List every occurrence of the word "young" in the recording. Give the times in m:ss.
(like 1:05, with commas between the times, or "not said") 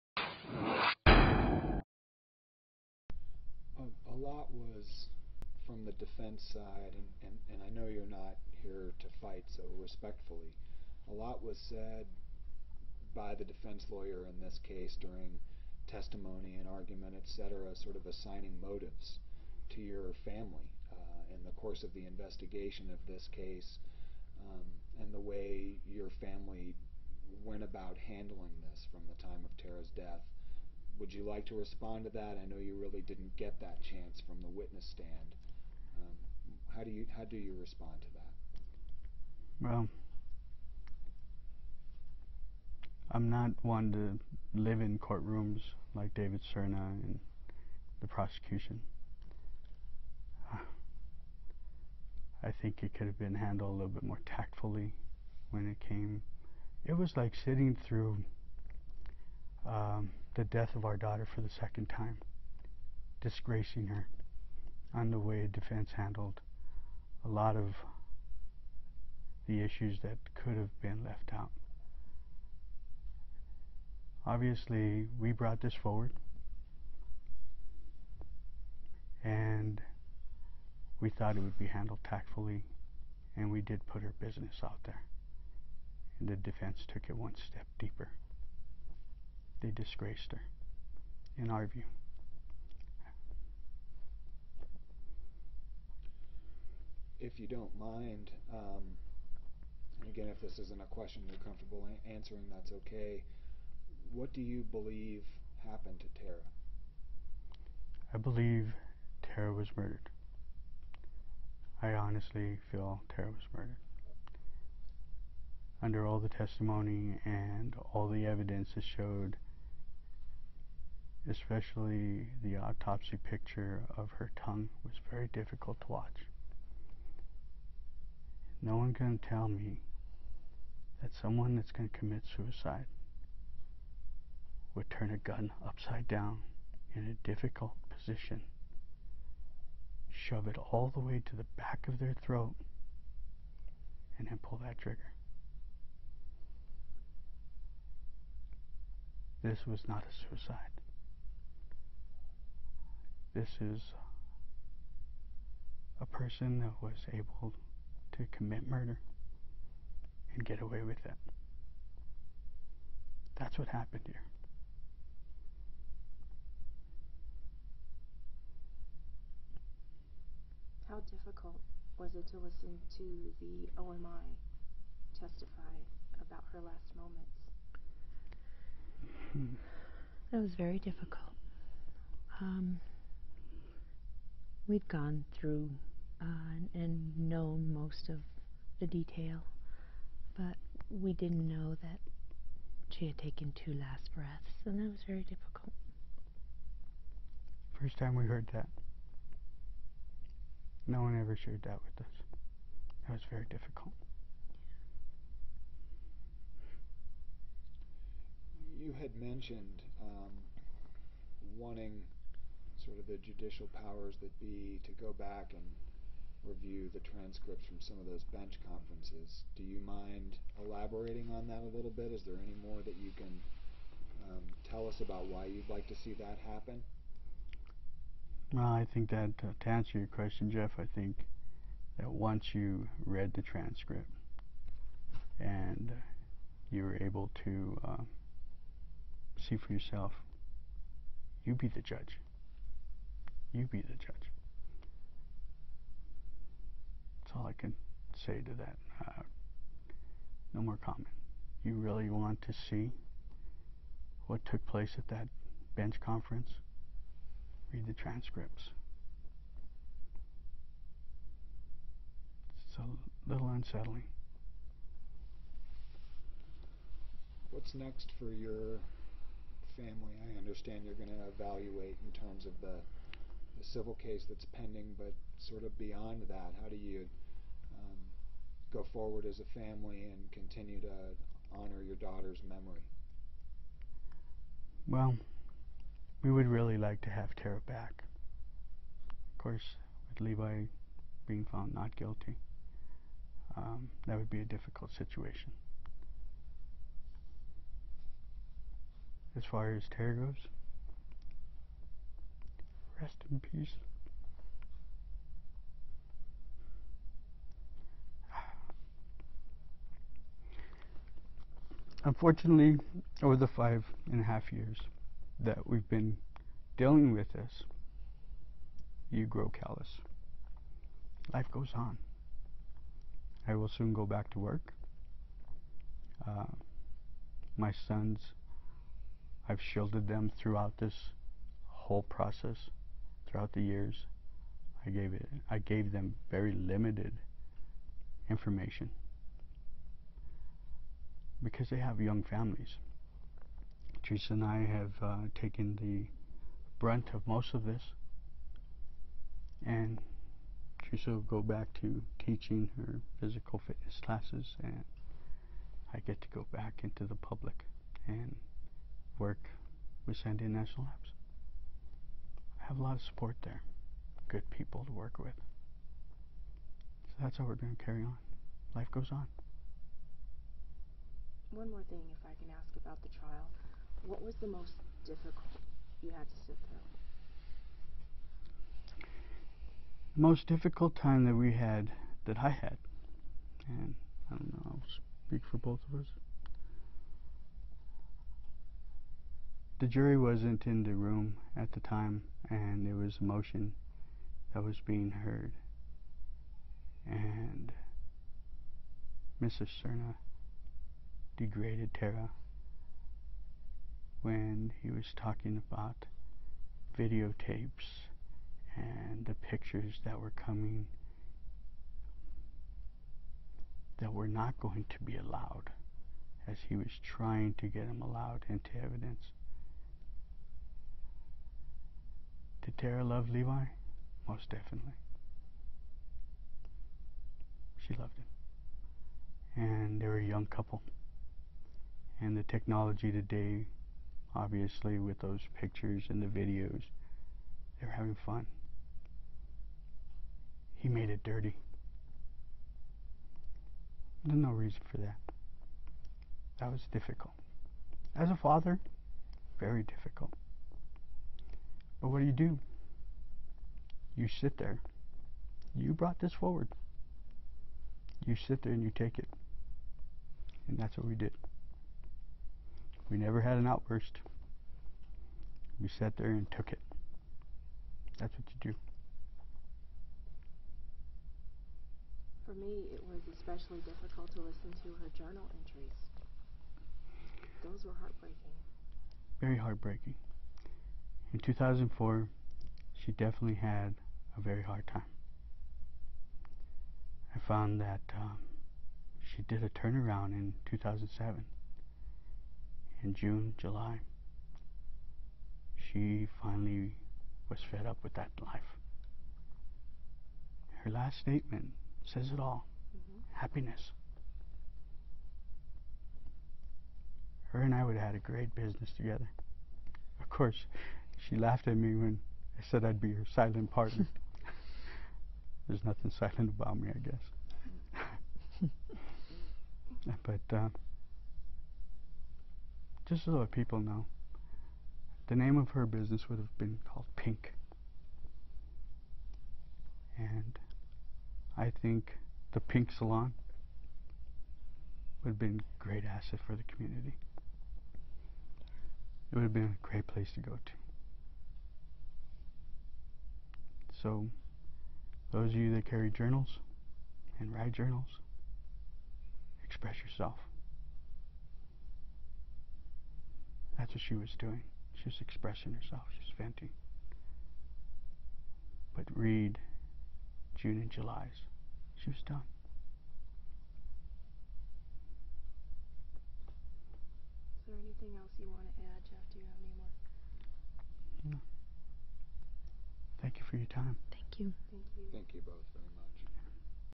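5:41, 7:10.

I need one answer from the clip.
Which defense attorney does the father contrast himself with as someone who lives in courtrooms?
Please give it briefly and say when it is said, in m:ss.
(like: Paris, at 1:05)
David Serna, at 0:46.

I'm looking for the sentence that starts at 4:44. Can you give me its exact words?
Well, we would really like to have Tera back.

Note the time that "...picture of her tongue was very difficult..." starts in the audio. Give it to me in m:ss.
2:03.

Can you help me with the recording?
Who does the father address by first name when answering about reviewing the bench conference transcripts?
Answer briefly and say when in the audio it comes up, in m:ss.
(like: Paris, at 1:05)
Jeff, at 3:50.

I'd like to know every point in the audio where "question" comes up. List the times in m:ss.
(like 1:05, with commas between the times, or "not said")
1:40, 3:50.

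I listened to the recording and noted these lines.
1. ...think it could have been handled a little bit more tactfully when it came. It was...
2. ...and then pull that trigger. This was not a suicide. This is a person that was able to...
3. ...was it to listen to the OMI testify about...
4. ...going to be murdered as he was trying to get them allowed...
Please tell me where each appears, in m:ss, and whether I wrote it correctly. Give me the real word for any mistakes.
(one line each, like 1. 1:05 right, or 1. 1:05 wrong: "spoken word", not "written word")
1. 0:52 right
2. 2:24 right
3. 2:51 right
4. 6:54 wrong: "allowed", not "murdered".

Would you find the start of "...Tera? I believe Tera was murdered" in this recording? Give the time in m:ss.
1:46.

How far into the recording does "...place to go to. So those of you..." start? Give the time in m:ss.
9:00.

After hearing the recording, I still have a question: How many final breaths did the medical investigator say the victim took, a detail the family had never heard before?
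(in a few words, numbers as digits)
2.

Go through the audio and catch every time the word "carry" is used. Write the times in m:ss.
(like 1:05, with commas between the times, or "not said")
6:07, 9:05.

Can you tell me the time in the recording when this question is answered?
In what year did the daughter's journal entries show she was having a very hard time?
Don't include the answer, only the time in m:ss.
8:01.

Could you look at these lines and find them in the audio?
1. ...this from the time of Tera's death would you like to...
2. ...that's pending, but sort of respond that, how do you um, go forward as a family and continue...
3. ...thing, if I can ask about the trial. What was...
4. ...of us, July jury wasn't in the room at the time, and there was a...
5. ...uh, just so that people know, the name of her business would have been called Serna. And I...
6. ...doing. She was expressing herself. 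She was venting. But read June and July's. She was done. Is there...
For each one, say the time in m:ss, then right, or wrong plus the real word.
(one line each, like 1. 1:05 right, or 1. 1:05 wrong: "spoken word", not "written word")
1. 0:28 right
2. 4:34 wrong: "beyond", not "respond"
3. 6:11 right
4. 6:25 wrong: "The", not "July"
5. 8:40 wrong: "Pink", not "Serna"
6. 9:14 right.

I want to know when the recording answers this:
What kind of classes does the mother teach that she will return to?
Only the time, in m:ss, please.
5:53.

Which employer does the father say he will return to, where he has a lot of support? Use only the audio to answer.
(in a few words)
Sandia National Labs.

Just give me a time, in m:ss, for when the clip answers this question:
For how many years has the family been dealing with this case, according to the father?
5:13.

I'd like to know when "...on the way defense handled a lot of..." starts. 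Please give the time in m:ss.
1:04.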